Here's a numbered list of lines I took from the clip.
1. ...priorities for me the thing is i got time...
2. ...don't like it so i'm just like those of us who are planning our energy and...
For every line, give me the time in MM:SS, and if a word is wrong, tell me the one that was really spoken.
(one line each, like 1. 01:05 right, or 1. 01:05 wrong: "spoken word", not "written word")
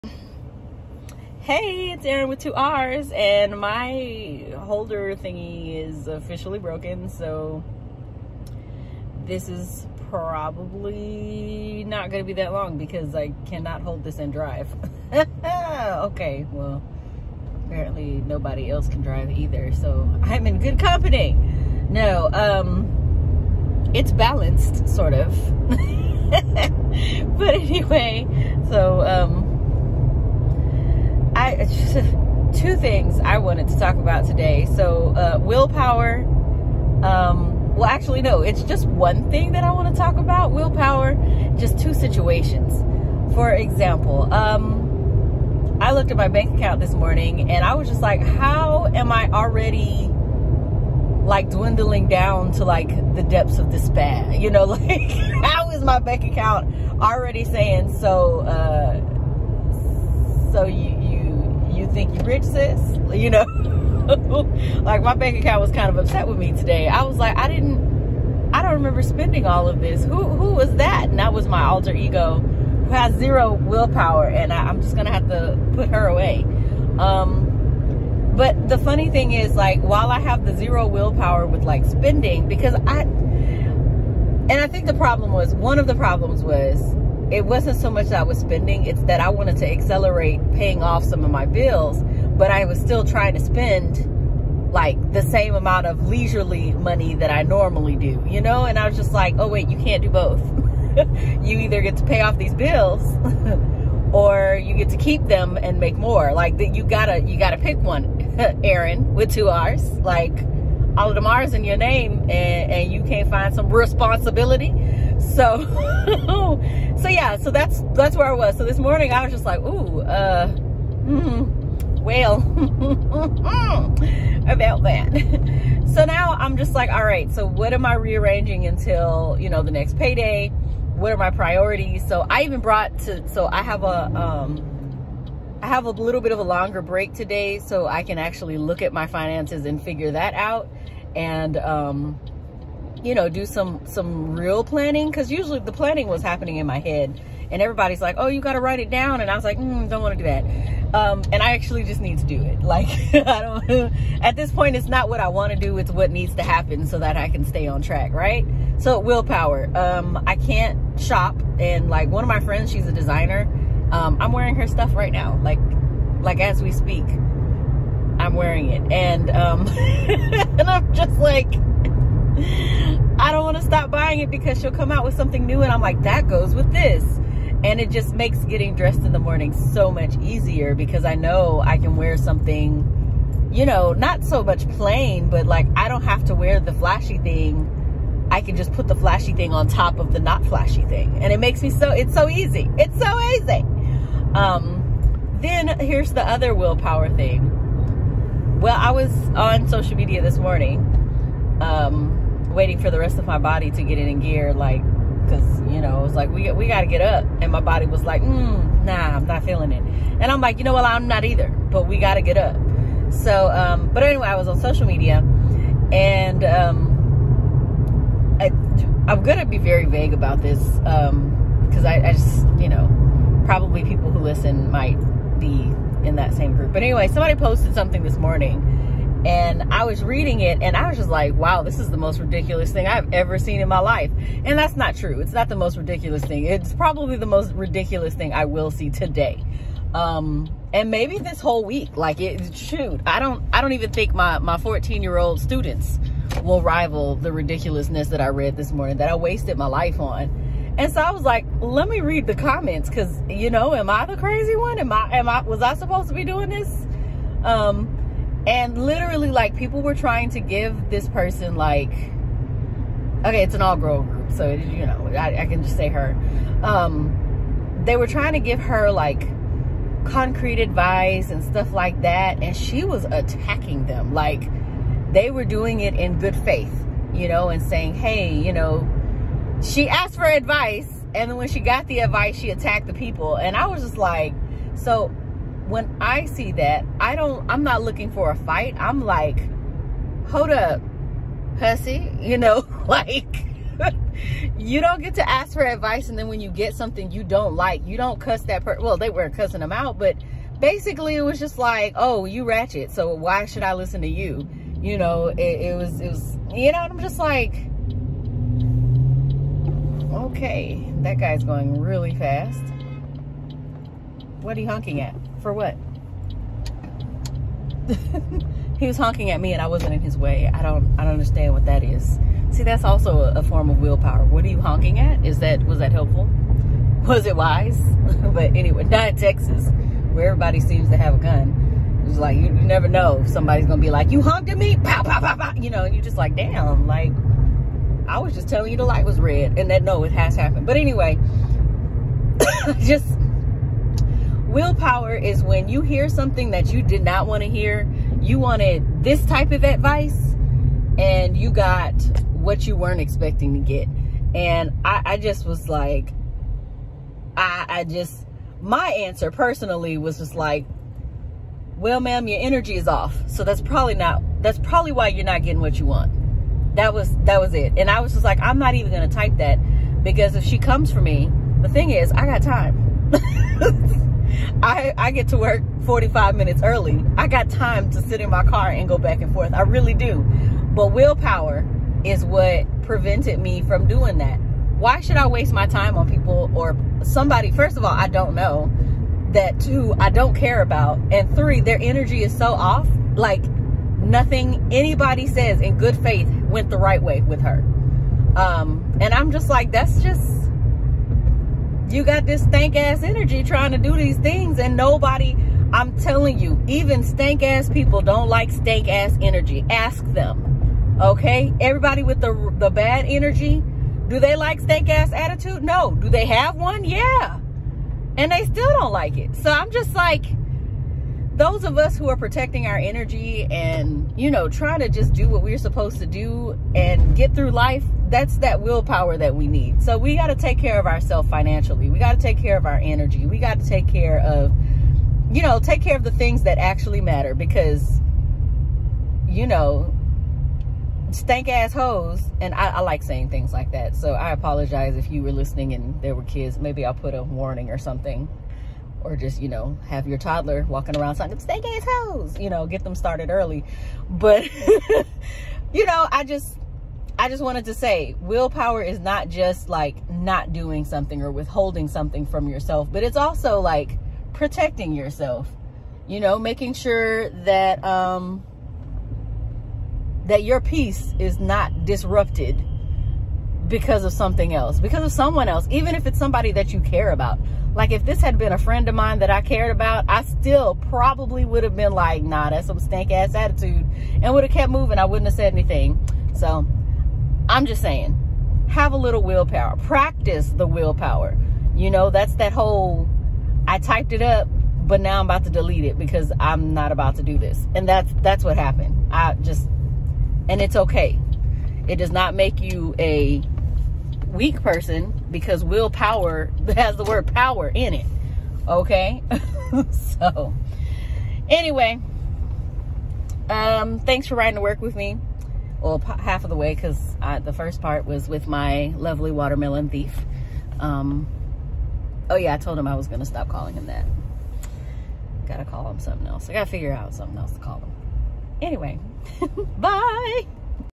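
1. 06:10 wrong: "comes", not "priorities"
2. 06:58 wrong: "protecting", not "planning".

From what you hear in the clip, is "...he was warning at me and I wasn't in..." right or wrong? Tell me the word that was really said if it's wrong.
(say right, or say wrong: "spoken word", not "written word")
wrong: "honking", not "warning".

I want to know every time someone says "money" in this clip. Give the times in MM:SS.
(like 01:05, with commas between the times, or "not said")
01:36.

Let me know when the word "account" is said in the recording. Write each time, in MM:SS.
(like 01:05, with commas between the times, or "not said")
00:46, 00:56, 01:05.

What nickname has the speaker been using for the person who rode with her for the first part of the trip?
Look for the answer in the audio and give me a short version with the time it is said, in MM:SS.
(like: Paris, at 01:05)
Watermelon thief, at 08:39.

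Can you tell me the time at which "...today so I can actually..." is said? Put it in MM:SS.
02:17.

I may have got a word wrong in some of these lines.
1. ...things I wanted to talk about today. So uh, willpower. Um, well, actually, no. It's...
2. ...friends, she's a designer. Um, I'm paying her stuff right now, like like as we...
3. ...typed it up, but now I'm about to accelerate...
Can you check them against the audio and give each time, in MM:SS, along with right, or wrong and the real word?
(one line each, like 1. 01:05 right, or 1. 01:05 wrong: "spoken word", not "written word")
1. 00:32 right
2. 02:42 wrong: "wearing", not "paying"
3. 08:13 wrong: "delete", not "accelerate".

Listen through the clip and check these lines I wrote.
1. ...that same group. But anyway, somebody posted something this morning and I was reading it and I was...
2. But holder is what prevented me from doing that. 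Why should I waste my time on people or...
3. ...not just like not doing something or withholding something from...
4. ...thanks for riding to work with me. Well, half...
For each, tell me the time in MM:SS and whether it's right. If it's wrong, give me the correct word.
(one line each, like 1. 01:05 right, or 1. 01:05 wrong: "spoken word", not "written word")
1. 03:46 right
2. 06:20 wrong: "willpower", not "holder"
3. 07:38 right
4. 08:33 right.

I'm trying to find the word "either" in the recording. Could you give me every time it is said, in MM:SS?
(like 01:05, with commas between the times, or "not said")
00:19, 01:41, 03:31.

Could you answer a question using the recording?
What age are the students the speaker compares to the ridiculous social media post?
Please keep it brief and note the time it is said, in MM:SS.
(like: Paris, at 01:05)
14, at 04:04.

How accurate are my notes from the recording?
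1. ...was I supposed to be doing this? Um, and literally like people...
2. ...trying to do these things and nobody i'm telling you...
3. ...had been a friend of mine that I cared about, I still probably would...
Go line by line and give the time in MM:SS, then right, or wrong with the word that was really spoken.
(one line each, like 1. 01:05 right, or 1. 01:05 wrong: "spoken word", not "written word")
1. 04:15 right
2. 06:43 right
3. 07:58 right.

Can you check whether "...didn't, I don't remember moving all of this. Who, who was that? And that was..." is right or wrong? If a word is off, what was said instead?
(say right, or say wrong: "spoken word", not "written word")
wrong: "spending", not "moving".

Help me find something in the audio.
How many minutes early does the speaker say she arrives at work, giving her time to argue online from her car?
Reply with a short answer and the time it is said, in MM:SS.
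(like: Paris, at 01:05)
45, at 06:15.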